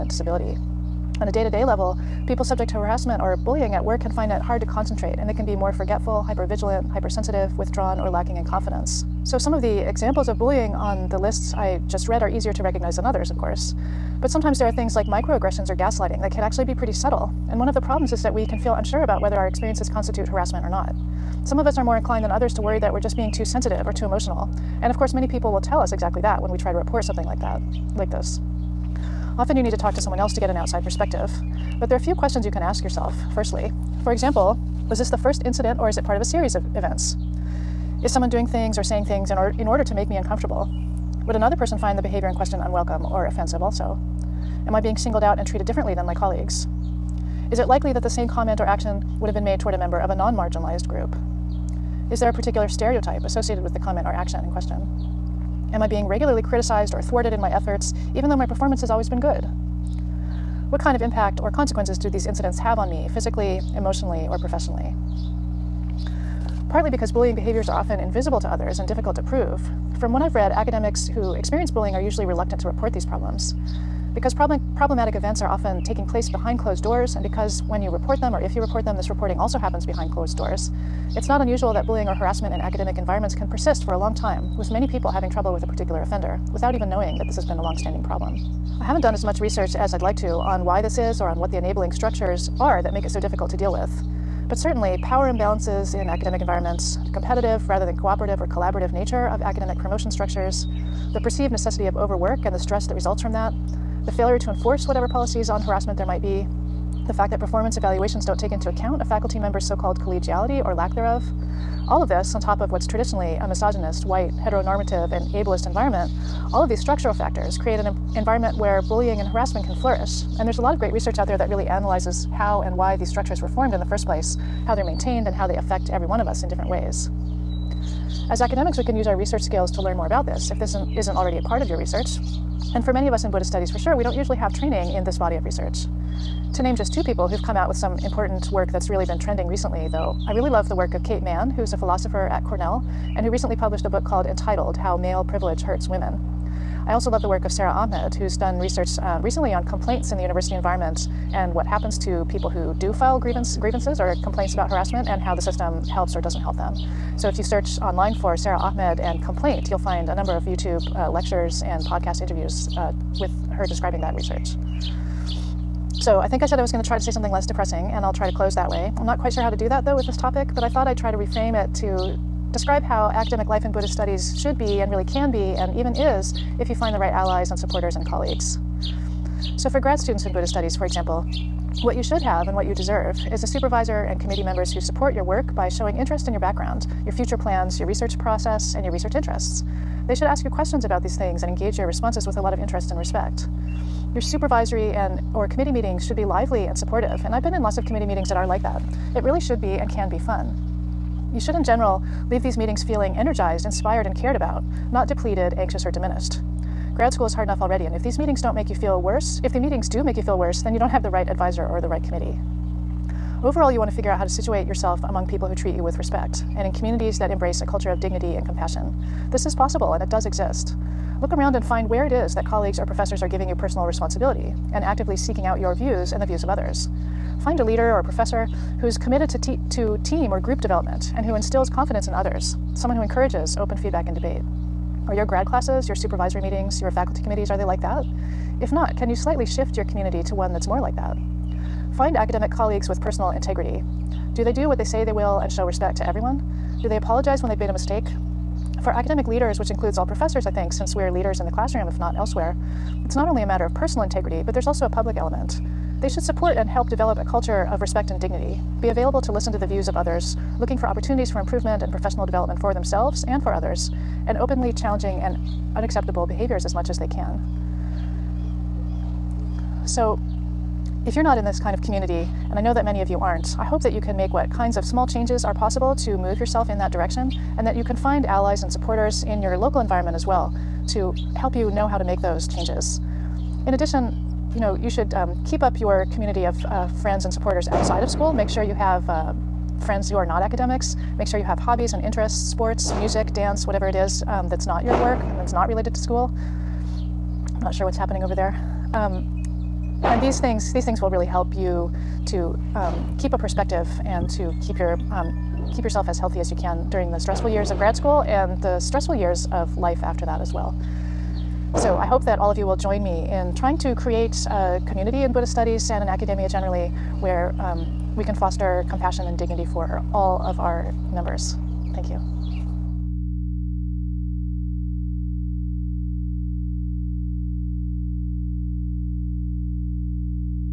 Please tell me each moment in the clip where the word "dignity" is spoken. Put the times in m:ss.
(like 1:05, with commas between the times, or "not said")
3:37, 4:18, 5:19.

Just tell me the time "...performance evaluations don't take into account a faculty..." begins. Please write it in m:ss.
1:47.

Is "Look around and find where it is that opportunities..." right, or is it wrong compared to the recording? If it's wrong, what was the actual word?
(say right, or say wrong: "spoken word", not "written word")
wrong: "colleagues", not "opportunities".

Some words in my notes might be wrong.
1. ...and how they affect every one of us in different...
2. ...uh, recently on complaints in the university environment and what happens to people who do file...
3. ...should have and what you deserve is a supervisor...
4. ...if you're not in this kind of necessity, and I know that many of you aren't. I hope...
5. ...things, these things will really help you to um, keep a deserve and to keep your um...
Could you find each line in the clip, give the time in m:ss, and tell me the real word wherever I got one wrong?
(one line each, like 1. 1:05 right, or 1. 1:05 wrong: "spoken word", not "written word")
1. 2:05 right
2. 2:29 right
3. 3:02 right
4. 4:31 wrong: "community", not "necessity"
5. 5:00 wrong: "perspective", not "deserve".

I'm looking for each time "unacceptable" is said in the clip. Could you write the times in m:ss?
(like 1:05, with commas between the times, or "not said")
4:25.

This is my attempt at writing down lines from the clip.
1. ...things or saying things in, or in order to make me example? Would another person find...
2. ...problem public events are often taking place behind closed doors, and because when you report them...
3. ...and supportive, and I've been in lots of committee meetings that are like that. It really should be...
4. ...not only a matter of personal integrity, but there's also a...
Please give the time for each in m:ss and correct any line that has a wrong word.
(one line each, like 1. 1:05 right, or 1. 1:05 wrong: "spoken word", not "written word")
1. 0:38 wrong: "uncomfortable", not "example"
2. 1:14 wrong: "problematic", not "public"
3. 3:16 right
4. 4:13 right.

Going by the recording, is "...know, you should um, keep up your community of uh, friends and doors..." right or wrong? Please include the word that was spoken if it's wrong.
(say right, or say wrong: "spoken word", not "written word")
wrong: "supporters", not "doors".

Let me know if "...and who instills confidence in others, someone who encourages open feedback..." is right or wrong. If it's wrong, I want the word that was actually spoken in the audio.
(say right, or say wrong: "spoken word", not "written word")
right.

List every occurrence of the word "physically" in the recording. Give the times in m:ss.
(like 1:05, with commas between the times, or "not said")
1:03.